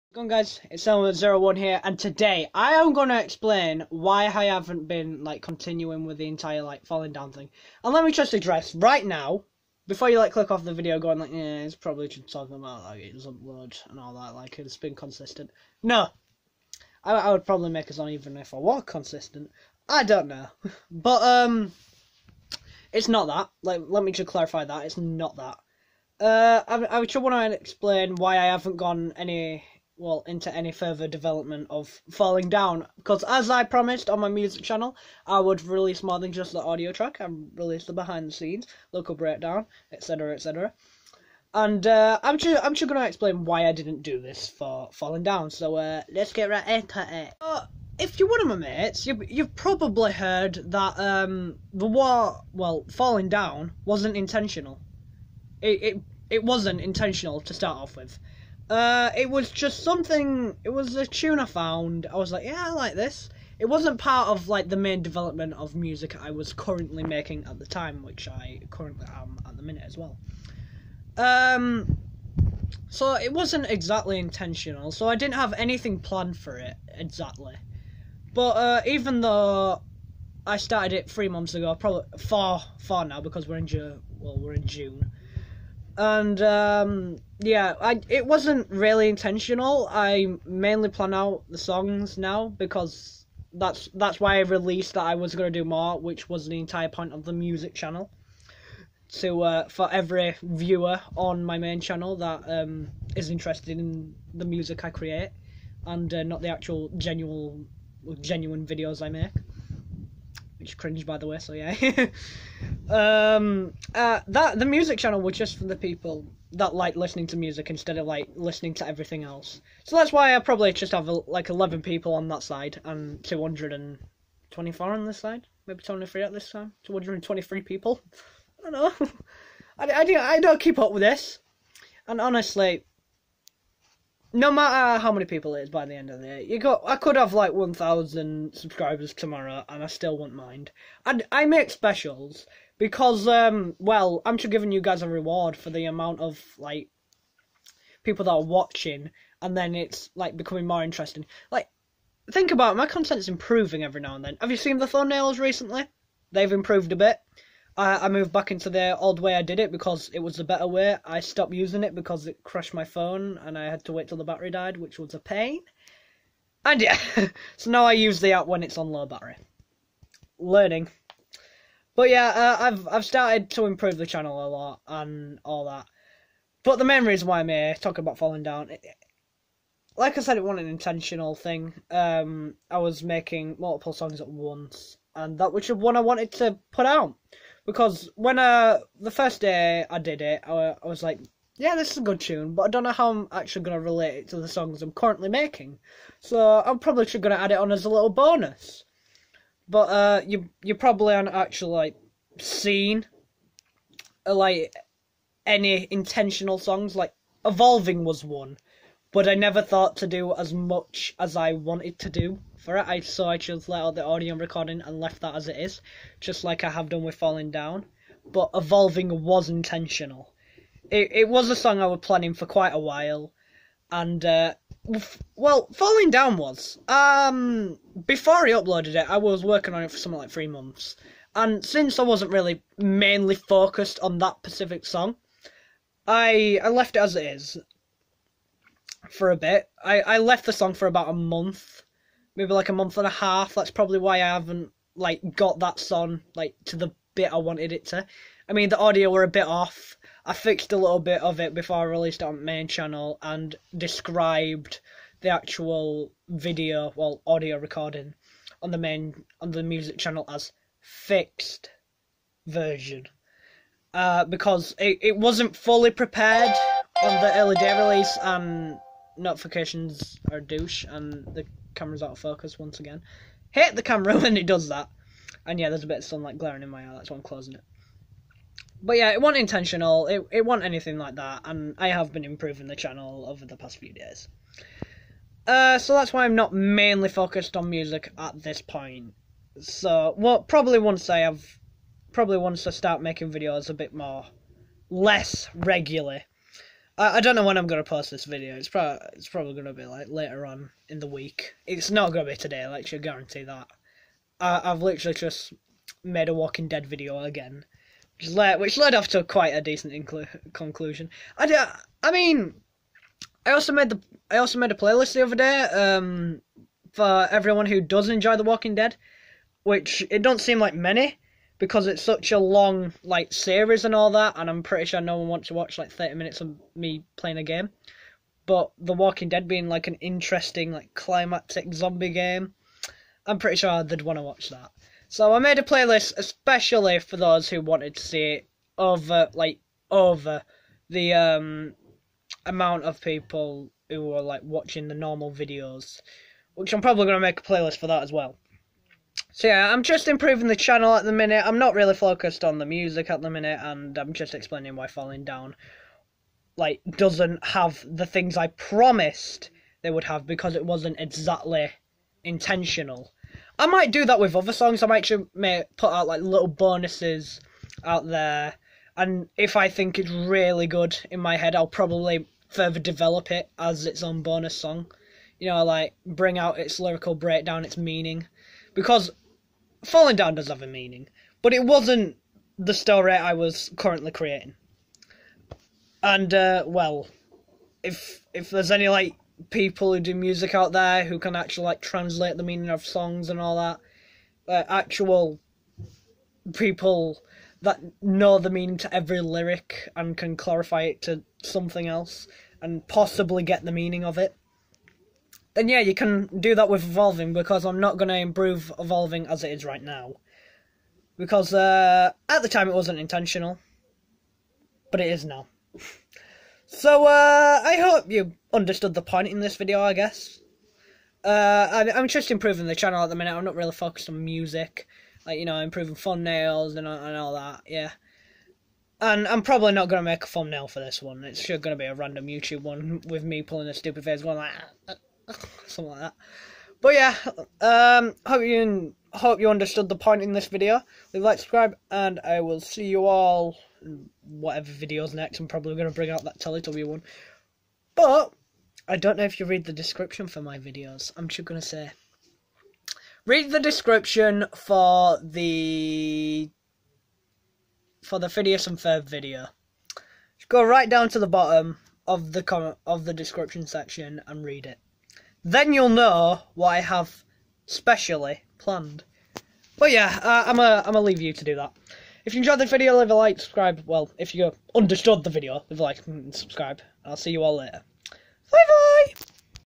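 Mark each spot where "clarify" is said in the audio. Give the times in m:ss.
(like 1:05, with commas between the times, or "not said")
0:24, 6:40.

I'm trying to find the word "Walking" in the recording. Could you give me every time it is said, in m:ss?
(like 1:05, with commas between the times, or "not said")
5:06, 5:18, 5:28.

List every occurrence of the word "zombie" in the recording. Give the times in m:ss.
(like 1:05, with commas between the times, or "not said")
5:31.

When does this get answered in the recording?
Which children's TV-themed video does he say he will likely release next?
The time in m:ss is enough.
7:26.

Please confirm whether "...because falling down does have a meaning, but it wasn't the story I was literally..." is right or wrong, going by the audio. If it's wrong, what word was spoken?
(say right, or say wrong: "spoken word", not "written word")
wrong: "currently", not "literally".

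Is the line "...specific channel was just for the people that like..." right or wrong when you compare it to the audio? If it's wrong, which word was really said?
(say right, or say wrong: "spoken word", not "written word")
wrong: "music", not "specific".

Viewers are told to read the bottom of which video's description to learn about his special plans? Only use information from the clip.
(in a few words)
Phineas and Ferb.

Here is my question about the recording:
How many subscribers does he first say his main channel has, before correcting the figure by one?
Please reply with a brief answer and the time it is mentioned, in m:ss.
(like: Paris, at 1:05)
224, at 2:03.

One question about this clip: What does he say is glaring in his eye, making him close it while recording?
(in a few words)
Sunlight.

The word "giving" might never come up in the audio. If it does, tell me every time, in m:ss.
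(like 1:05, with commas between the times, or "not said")
2:24.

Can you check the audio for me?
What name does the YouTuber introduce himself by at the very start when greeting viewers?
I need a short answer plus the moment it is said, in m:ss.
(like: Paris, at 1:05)
Elmo01, at 0:00.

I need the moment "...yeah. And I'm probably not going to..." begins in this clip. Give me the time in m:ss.
7:07.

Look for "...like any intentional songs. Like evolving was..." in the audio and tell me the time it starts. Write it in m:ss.
3:24.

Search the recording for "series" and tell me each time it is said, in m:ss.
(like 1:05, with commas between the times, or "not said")
5:23.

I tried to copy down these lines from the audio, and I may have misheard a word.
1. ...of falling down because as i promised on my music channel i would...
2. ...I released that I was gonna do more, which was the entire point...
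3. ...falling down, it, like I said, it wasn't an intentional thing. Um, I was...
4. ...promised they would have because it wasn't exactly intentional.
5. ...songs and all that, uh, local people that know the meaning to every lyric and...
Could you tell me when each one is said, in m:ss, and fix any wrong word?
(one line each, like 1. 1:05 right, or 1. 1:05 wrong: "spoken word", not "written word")
1. 0:31 right
2. 1:34 right
3. 2:58 right
4. 5:58 right
5. 6:32 wrong: "actual", not "local".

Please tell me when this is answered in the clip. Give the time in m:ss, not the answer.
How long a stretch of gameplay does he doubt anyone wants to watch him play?
5:25.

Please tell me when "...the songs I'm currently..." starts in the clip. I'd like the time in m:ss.
3:14.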